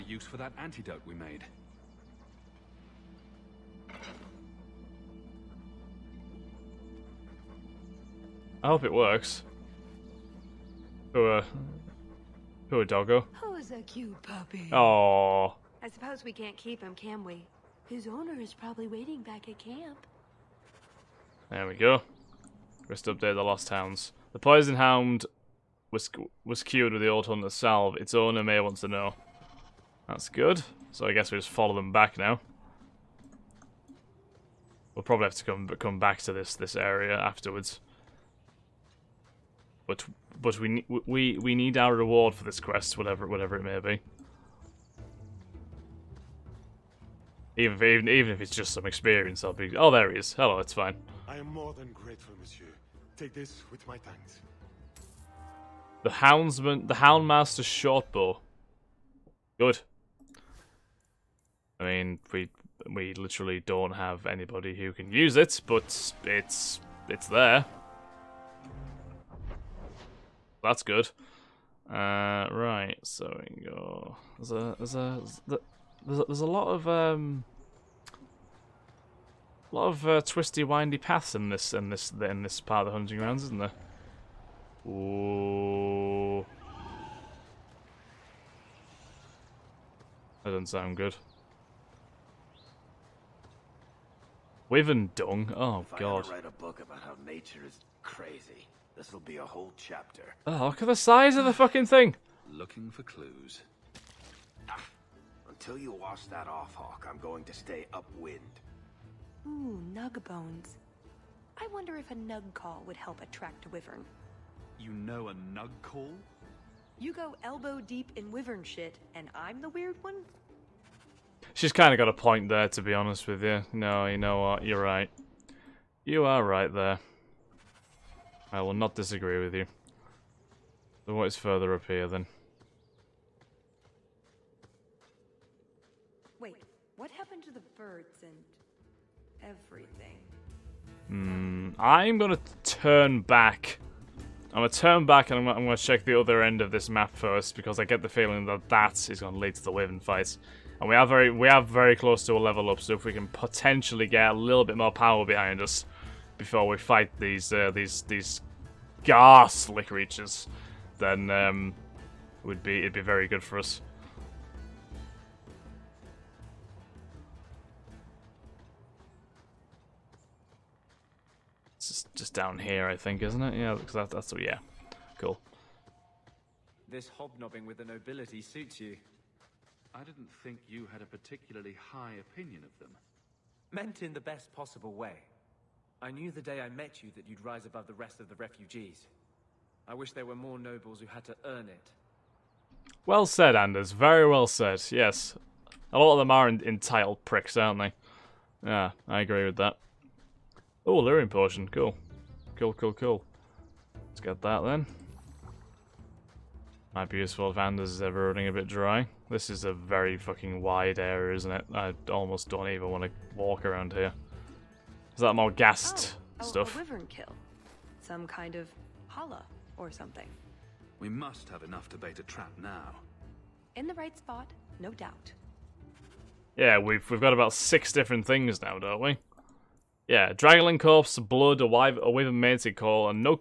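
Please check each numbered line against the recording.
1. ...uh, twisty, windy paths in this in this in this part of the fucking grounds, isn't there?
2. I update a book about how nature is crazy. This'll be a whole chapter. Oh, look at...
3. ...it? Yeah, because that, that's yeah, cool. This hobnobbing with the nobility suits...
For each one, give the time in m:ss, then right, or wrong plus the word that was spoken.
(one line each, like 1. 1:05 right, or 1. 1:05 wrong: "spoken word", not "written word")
1. 1:20 wrong: "hunting", not "fucking"
2. 1:36 wrong: "write", not "update"
3. 2:53 right.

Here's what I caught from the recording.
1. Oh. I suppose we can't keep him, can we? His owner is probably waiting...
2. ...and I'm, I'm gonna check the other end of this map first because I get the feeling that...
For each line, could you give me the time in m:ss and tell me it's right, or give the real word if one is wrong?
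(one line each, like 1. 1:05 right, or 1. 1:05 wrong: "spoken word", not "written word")
1. 0:14 right
2. 2:25 right.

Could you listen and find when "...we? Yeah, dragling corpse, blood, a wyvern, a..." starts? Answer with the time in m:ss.
3:49.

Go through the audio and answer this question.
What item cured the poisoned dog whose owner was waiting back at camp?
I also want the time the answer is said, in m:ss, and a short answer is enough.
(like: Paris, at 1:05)
The old hunter's salve, at 0:27.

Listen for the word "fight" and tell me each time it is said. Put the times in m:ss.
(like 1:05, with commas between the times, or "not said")
2:30, 2:36.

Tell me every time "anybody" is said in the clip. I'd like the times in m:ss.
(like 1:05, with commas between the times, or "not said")
1:04.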